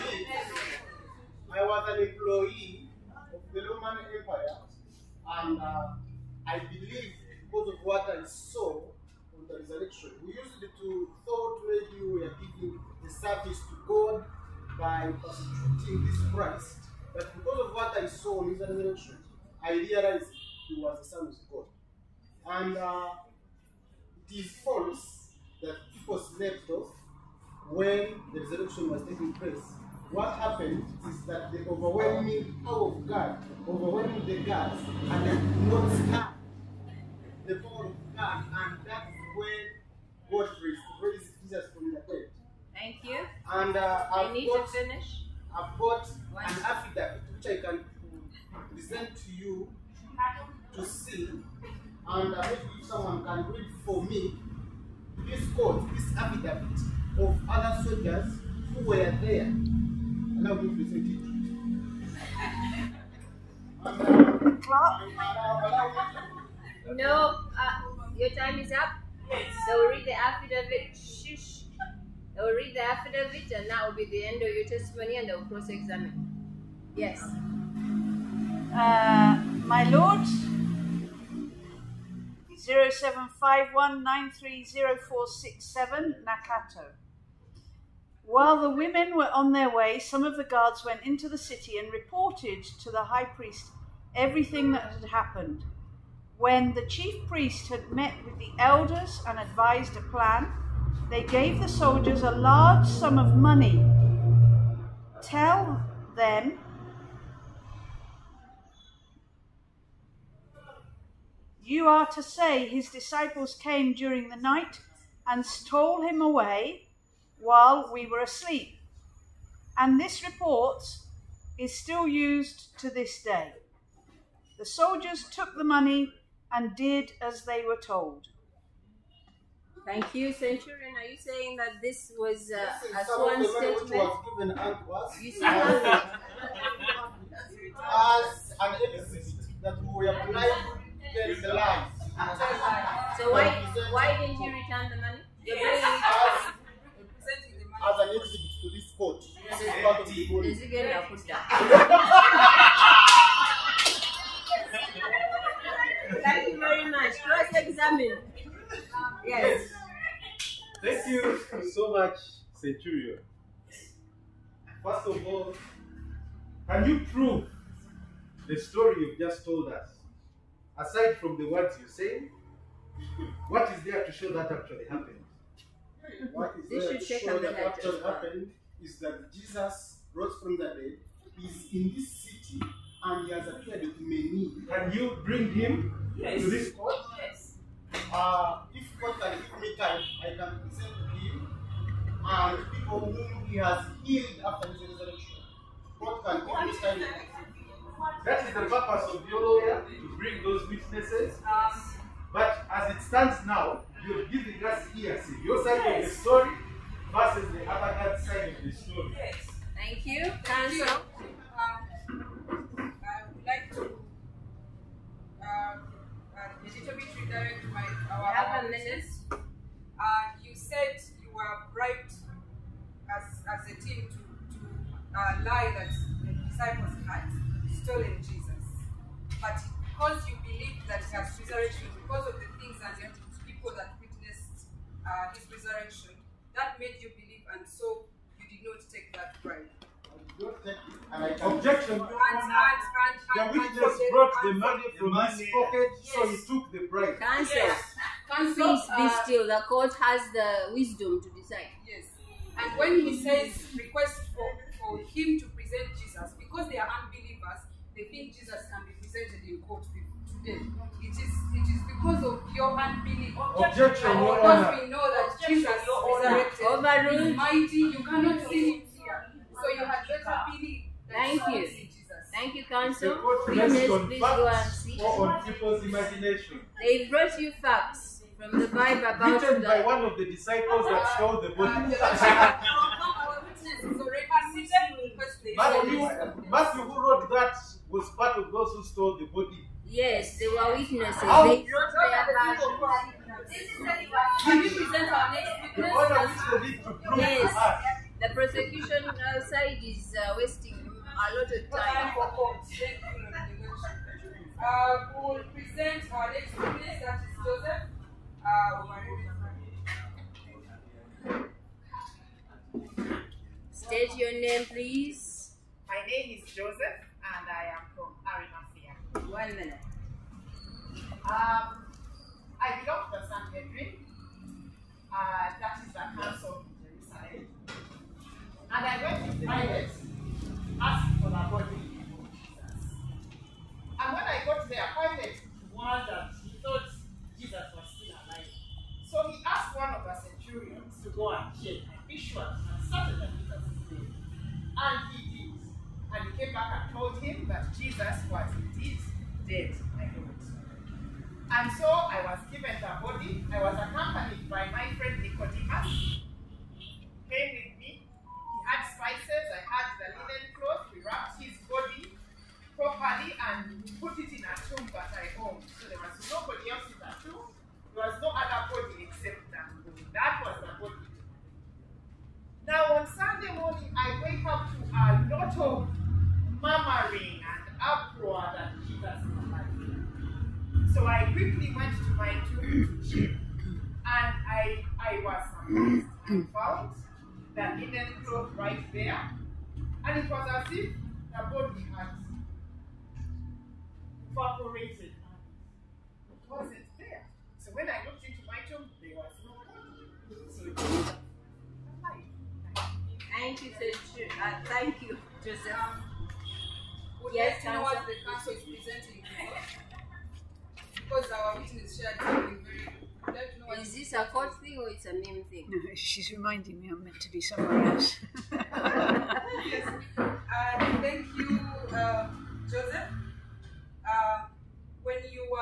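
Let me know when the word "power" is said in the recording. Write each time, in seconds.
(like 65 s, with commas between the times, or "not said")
32 s, 37 s.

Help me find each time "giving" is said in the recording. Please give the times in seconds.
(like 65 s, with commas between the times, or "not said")
12 s, 204 s.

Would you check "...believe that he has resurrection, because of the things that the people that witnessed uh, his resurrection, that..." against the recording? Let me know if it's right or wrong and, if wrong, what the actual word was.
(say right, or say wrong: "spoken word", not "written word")
right.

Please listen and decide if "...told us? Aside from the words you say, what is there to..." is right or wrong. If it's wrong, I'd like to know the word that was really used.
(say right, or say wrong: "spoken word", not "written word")
right.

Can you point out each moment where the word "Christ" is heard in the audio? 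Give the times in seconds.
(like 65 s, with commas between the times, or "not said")
16 s.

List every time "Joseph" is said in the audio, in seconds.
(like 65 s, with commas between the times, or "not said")
307 s, 316 s, 405 s, 422 s.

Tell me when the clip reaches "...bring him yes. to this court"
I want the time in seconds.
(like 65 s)
185 s.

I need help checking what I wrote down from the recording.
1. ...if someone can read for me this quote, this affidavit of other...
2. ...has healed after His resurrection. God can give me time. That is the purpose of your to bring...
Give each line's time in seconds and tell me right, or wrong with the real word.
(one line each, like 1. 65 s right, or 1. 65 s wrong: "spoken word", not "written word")
1. 52 s right
2. 193 s right.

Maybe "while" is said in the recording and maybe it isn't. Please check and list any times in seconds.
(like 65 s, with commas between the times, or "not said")
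88 s, 117 s.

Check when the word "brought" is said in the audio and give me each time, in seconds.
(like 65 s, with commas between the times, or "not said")
244 s, 277 s.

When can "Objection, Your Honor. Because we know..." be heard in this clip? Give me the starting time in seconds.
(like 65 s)
263 s.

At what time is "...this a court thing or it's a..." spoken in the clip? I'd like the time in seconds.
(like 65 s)
413 s.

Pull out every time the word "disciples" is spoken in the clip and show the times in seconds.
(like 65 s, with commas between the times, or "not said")
112 s, 226 s, 280 s.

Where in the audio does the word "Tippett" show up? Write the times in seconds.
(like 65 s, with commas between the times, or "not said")
not said.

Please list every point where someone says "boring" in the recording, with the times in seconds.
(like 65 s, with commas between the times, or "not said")
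not said.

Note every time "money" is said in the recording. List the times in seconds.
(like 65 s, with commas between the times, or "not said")
103 s, 125 s, 145 s, 244 s.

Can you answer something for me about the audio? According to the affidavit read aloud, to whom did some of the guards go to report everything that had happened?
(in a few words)
The high priest.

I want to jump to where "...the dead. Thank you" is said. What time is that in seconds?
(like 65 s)
41 s.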